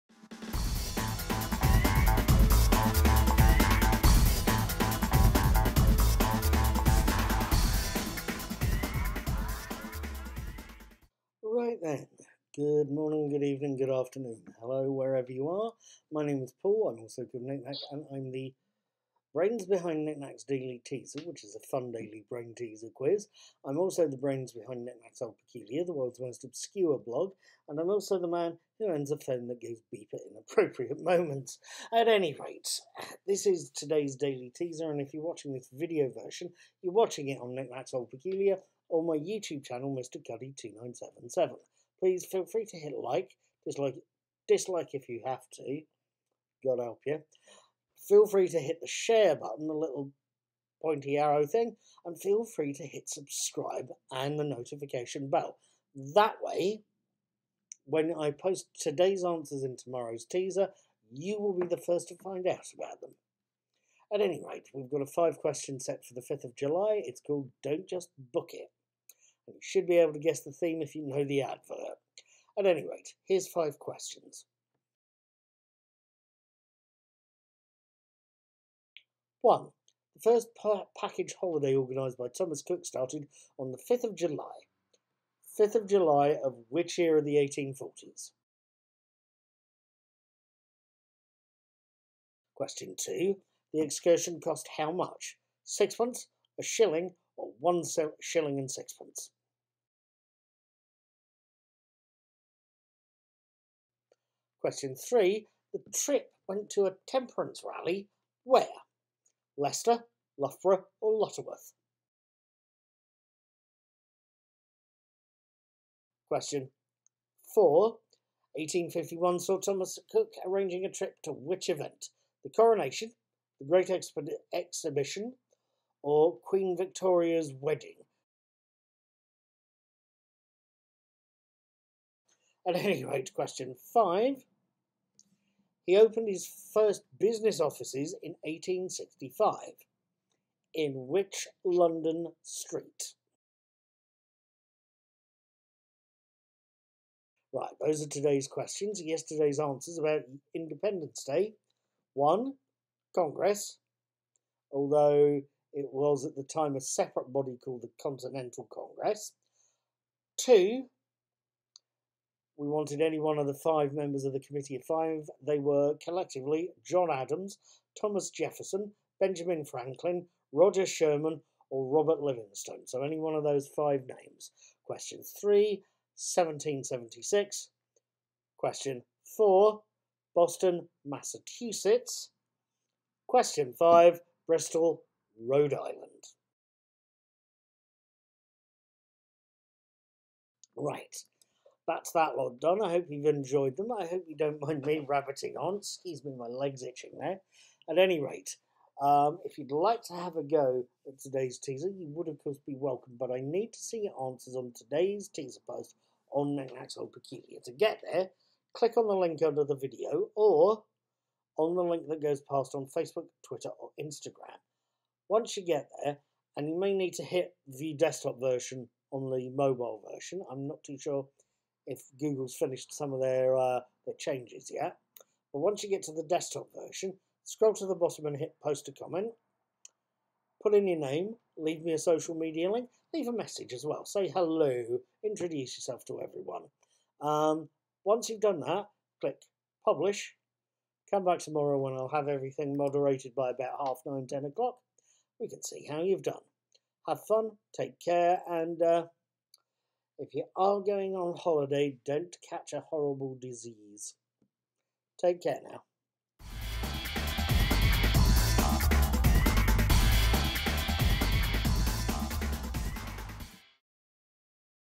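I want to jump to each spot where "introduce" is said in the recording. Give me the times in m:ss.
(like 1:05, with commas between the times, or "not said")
3:55.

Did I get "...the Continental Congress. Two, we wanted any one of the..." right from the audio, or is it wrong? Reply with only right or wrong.
right.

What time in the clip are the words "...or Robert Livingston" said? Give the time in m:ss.
2:51.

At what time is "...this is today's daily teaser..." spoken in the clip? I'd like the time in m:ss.
0:33.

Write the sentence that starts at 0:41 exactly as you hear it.
Please feel free to hit like, dislike, dislike if you have to.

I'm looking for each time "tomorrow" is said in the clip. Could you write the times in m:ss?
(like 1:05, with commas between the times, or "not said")
0:59, 4:01.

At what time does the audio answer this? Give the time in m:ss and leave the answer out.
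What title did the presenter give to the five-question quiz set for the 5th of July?
1:07.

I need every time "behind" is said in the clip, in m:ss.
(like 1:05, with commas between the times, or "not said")
0:19, 0:24.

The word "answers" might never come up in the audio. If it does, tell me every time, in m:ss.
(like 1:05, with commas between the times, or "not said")
0:59, 2:29, 3:24.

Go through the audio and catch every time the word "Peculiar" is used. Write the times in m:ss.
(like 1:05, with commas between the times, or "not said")
0:25, 0:38, 3:27.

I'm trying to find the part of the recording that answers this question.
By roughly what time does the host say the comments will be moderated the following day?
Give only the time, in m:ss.
4:03.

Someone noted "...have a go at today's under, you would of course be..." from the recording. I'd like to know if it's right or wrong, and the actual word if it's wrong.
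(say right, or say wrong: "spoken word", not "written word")
wrong: "teaser", not "under".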